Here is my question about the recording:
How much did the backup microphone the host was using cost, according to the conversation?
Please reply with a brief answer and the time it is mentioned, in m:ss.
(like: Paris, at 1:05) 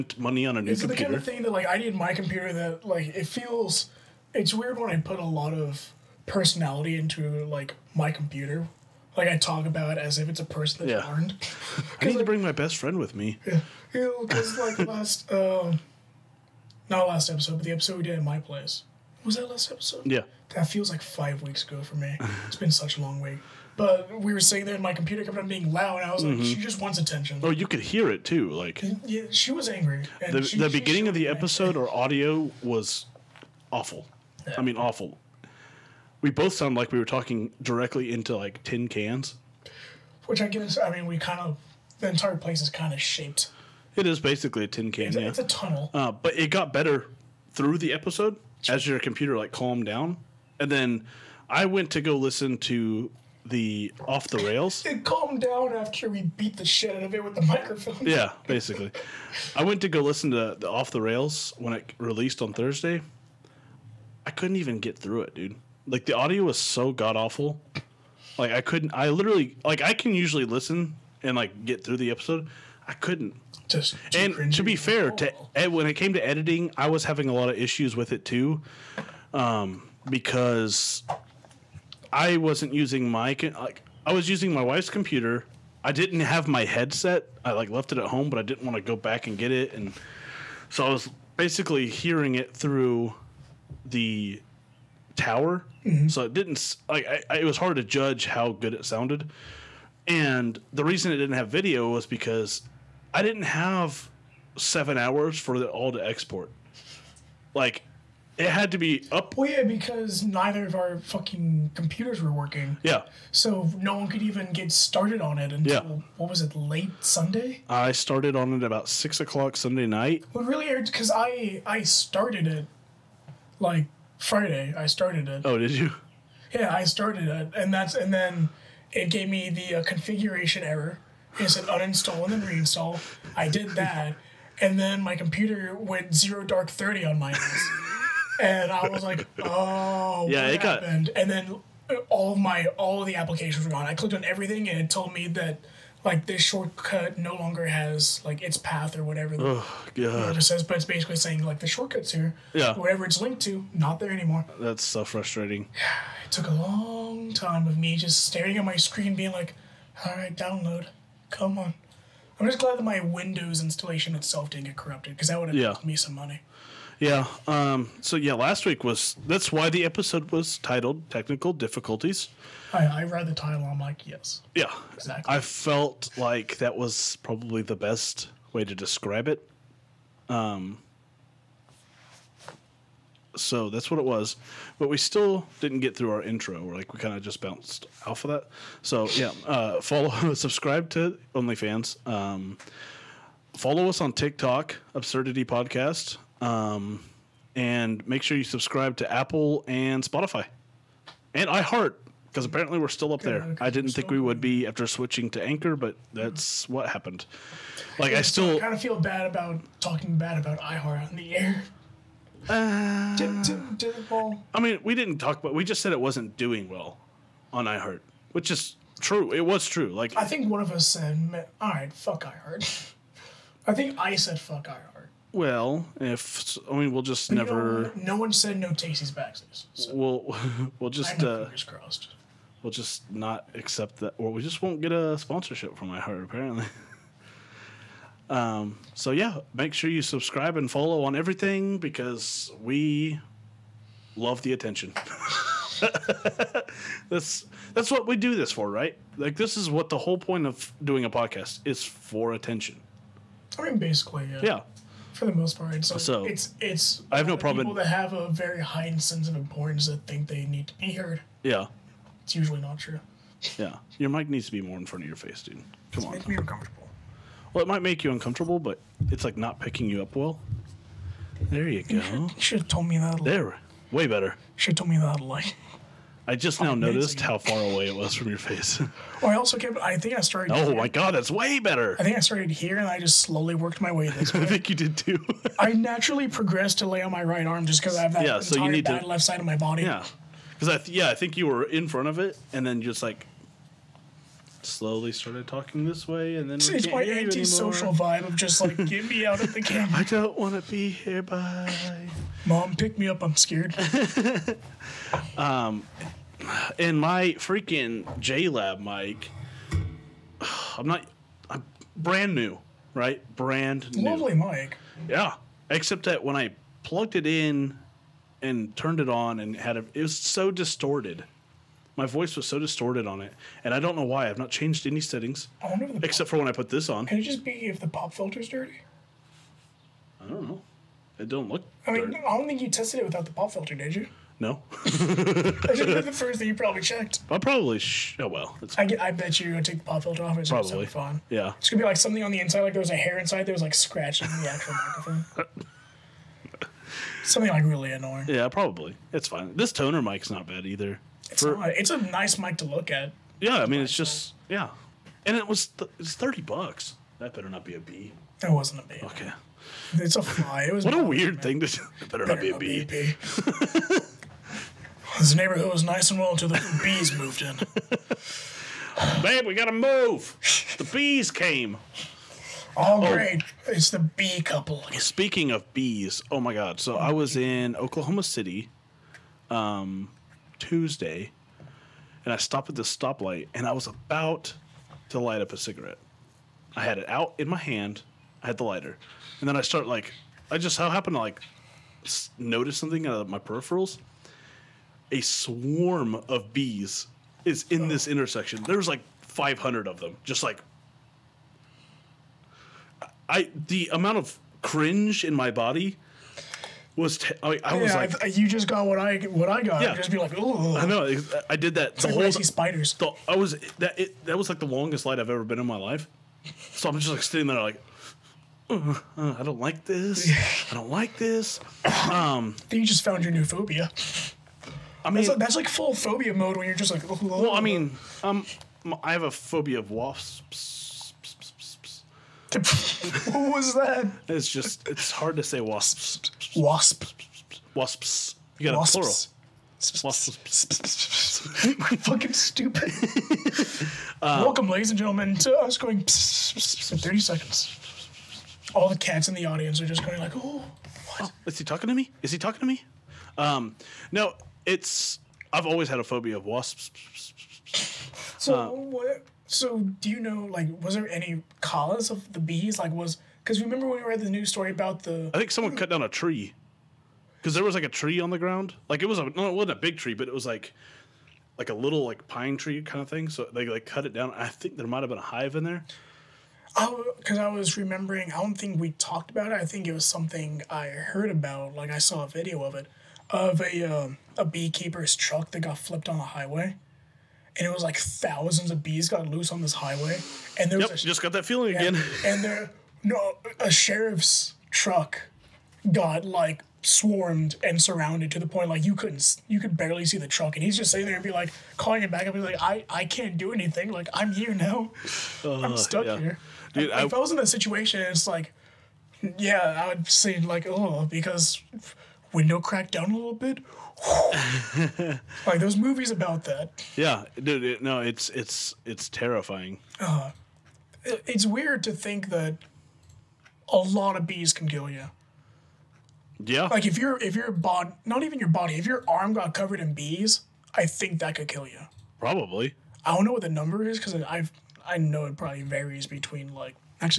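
30 dollars, at 5:56.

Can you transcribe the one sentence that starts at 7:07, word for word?
well, I mean, um, I have a phobia of wasps.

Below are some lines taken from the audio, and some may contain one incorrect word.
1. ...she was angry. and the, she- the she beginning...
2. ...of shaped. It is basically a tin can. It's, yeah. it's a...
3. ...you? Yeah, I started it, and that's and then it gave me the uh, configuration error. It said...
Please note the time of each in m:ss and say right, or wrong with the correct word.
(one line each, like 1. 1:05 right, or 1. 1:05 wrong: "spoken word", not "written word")
1. 0:29 right
2. 0:42 right
3. 2:05 right.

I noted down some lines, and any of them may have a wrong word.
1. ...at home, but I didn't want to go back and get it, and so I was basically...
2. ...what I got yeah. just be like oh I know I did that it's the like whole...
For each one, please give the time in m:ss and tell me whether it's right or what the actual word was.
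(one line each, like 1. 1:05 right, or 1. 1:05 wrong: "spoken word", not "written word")
1. 1:27 right
2. 6:49 right.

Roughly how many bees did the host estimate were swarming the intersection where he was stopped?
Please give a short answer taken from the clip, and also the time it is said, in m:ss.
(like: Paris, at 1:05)
500, at 6:39.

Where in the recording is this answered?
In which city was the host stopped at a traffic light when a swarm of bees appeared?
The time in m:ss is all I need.
6:17.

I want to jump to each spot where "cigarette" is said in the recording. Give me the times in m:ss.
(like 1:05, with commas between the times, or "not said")
6:25.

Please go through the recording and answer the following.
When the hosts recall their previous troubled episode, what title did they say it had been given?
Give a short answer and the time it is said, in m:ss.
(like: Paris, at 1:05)
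Technical Difficulties, at 2:51.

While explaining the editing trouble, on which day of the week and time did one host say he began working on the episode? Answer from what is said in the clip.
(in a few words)
Sunday, 6 o'clock.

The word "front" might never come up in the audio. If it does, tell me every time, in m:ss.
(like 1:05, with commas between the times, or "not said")
4:24, 4:51.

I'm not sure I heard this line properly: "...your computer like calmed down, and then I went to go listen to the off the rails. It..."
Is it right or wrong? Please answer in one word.
right.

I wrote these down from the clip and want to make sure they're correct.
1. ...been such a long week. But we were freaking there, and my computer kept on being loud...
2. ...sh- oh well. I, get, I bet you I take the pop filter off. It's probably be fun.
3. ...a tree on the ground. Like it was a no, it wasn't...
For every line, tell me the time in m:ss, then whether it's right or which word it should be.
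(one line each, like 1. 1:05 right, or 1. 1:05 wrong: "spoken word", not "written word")
1. 0:22 wrong: "sitting", not "freaking"
2. 5:37 right
3. 7:47 right.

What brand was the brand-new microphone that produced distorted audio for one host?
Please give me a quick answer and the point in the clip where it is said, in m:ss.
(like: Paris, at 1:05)
JLab, at 5:08.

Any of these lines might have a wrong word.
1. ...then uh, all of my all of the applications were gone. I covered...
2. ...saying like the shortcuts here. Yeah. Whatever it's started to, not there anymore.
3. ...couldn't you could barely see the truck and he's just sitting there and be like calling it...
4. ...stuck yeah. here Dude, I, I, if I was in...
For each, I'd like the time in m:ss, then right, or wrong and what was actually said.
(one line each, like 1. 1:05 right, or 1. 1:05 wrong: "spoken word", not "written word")
1. 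2:21 wrong: "clicked", not "covered"
2. 2:31 wrong: "linked", not "started"
3. 8:18 right
4. 8:25 right.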